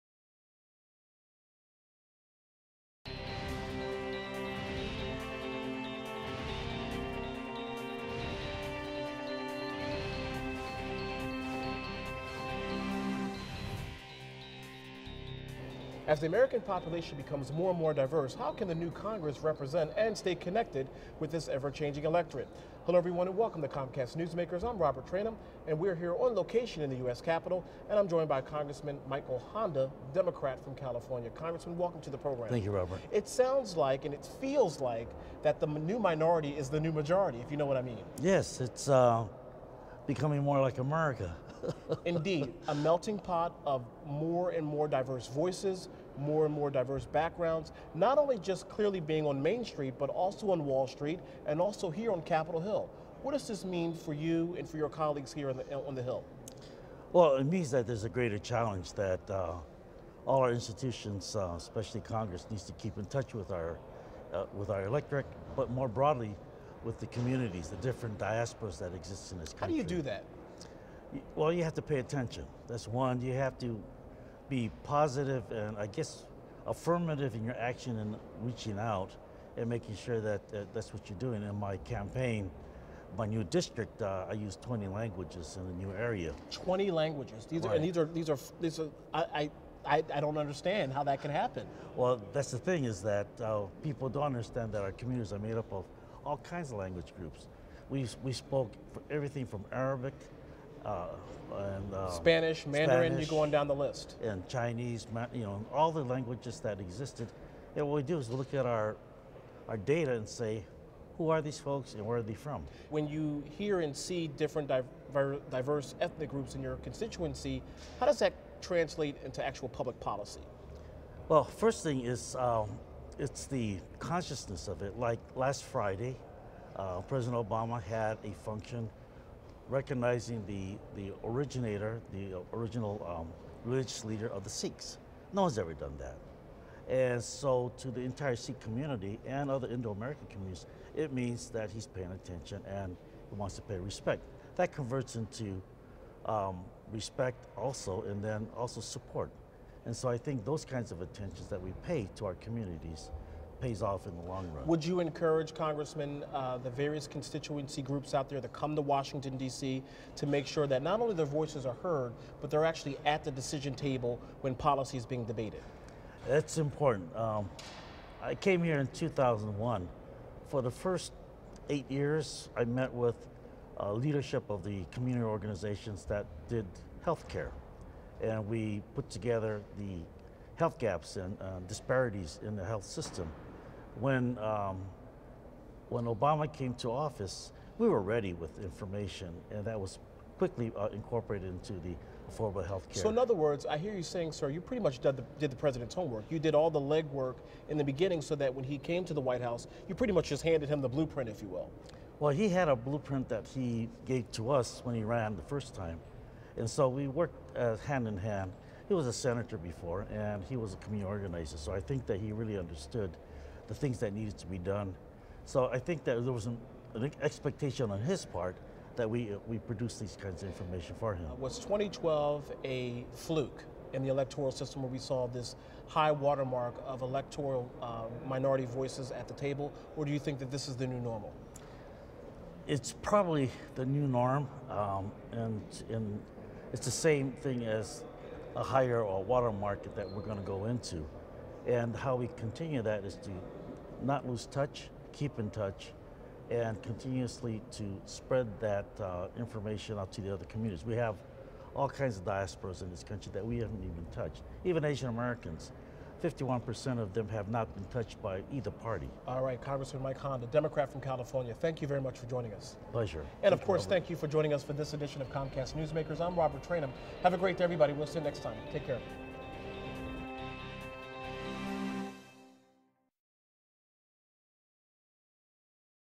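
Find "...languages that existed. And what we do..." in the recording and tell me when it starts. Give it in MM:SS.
01:46.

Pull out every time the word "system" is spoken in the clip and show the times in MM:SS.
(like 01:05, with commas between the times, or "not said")
03:02, 03:44.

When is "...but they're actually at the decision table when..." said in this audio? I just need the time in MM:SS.
02:42.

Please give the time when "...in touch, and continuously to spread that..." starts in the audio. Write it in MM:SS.
04:05.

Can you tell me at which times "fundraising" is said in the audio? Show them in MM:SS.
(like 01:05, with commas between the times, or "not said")
not said.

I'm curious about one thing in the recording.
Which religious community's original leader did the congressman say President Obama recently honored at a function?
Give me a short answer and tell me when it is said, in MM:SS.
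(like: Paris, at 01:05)
Sikhs, at 02:14.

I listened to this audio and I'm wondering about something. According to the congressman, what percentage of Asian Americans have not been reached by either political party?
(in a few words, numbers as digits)
51%.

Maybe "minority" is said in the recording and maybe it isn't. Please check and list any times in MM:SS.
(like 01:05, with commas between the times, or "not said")
00:35, 03:48.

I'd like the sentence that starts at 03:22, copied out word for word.
Well, he had a blueprint that he gave to us when he ran the first time.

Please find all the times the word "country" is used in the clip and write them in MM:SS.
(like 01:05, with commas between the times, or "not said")
01:09, 04:13.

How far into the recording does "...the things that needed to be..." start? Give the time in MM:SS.
03:33.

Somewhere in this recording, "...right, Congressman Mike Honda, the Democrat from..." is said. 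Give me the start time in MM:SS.
04:19.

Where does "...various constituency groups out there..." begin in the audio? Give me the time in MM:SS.
02:36.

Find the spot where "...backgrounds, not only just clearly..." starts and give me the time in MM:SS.
00:47.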